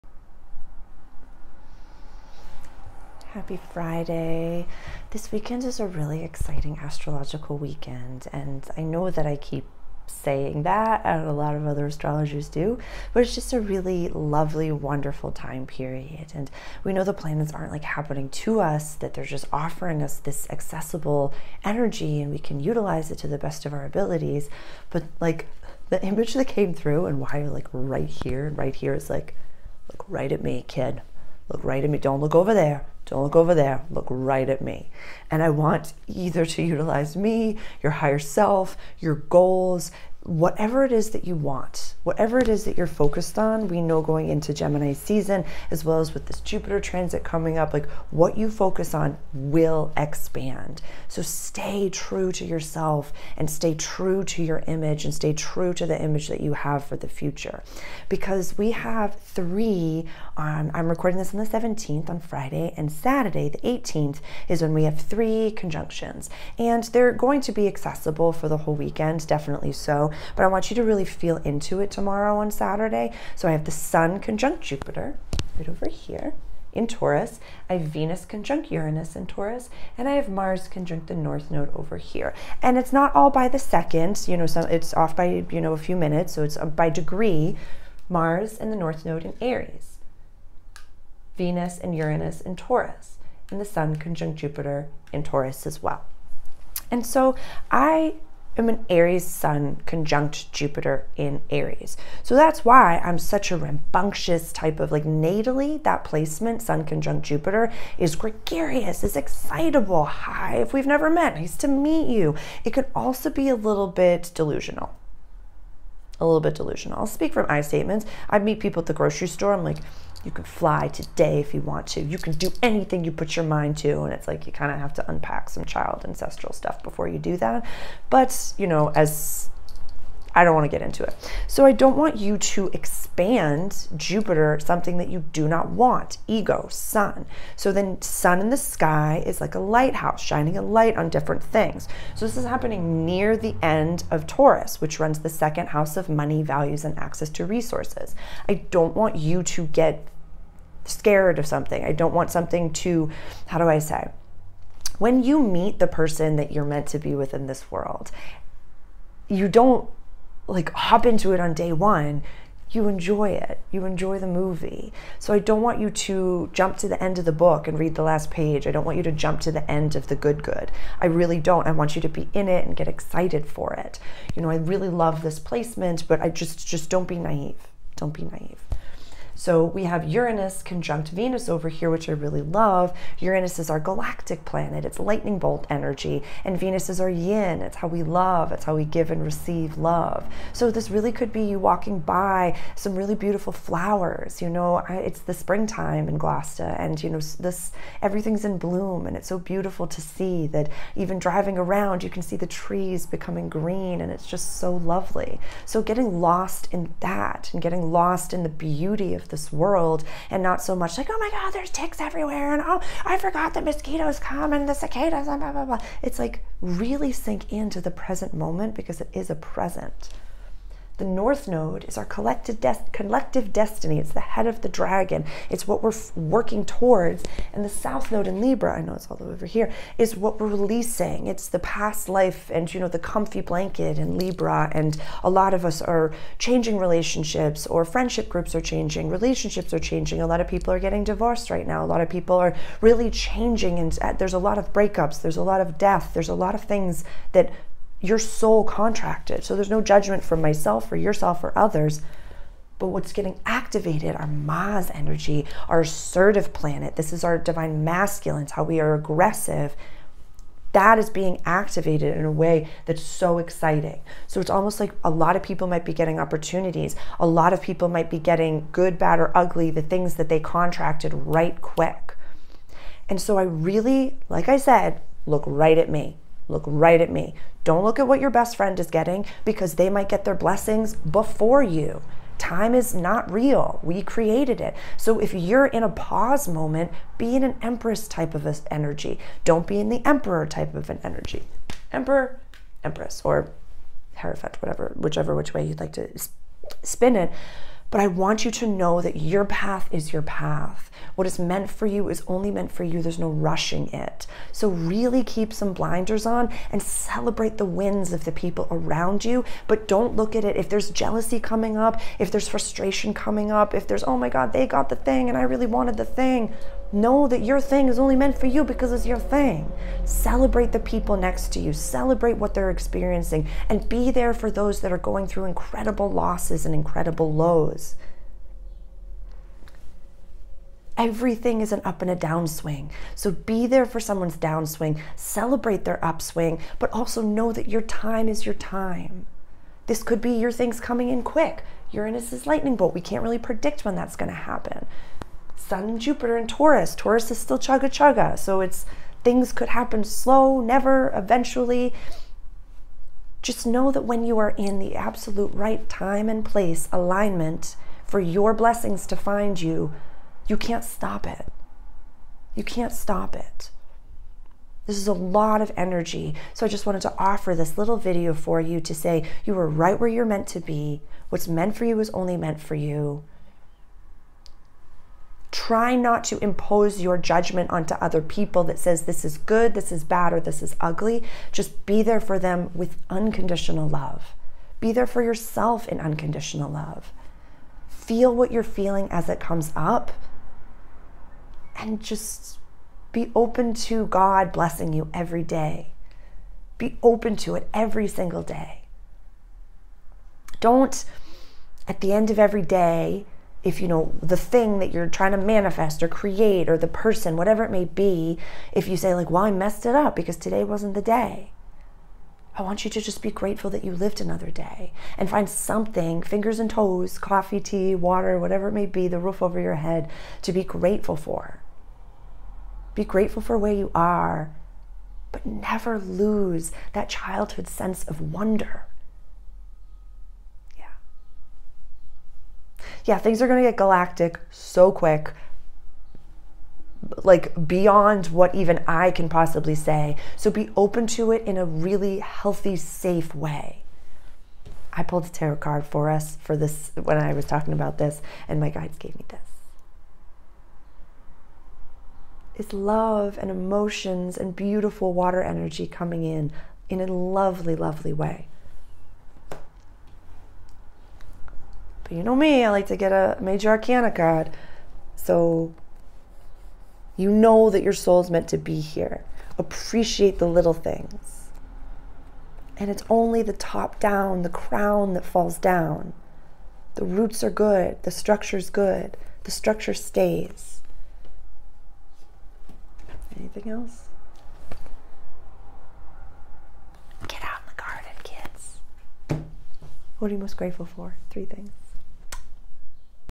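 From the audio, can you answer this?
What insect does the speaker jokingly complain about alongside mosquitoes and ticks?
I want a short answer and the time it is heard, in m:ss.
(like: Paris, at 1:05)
cicadas, at 3:34.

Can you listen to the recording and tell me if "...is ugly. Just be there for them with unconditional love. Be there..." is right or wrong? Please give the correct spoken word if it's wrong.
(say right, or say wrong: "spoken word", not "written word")
right.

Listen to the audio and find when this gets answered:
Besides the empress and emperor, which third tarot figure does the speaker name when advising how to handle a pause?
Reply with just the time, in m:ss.
4:54.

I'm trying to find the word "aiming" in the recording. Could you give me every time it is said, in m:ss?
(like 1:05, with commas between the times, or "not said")
not said.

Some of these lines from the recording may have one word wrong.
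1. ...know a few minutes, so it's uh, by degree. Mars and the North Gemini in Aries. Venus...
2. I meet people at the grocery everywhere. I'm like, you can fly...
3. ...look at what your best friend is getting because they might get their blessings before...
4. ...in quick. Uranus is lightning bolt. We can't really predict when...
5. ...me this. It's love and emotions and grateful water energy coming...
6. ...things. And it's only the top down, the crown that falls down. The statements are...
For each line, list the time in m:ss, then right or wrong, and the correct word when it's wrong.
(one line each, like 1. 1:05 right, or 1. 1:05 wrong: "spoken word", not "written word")
1. 1:25 wrong: "Node", not "Gemini"
2. 1:58 wrong: "store", not "everywhere"
3. 4:37 right
4. 5:41 right
5. 7:29 wrong: "beautiful", not "grateful"
6. 7:50 wrong: "roots", not "statements".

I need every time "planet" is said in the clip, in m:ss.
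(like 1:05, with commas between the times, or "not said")
0:17, 3:04, 4:16.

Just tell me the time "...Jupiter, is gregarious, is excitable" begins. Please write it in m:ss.
1:47.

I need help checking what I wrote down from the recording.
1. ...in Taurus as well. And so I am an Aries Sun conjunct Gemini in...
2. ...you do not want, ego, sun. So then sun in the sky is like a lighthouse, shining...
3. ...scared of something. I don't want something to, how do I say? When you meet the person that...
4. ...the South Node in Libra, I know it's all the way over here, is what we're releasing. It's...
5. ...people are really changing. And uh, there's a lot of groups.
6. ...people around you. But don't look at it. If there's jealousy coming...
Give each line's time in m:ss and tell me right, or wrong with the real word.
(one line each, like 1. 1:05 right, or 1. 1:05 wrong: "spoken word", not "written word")
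1. 1:35 wrong: "Jupiter", not "Gemini"
2. 2:15 right
3. 2:30 right
4. 3:47 right
5. 4:02 wrong: "breakups", not "groups"
6. 5:08 right.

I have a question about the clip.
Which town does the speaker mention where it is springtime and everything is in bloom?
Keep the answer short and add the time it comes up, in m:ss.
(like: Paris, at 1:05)
Gloucester, at 3:16.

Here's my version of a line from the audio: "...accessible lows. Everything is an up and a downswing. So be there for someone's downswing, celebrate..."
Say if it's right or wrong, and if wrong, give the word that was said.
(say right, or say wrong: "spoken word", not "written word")
wrong: "incredible", not "accessible".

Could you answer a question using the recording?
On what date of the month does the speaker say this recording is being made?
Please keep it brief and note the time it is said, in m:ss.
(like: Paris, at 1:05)
17th, at 1:01.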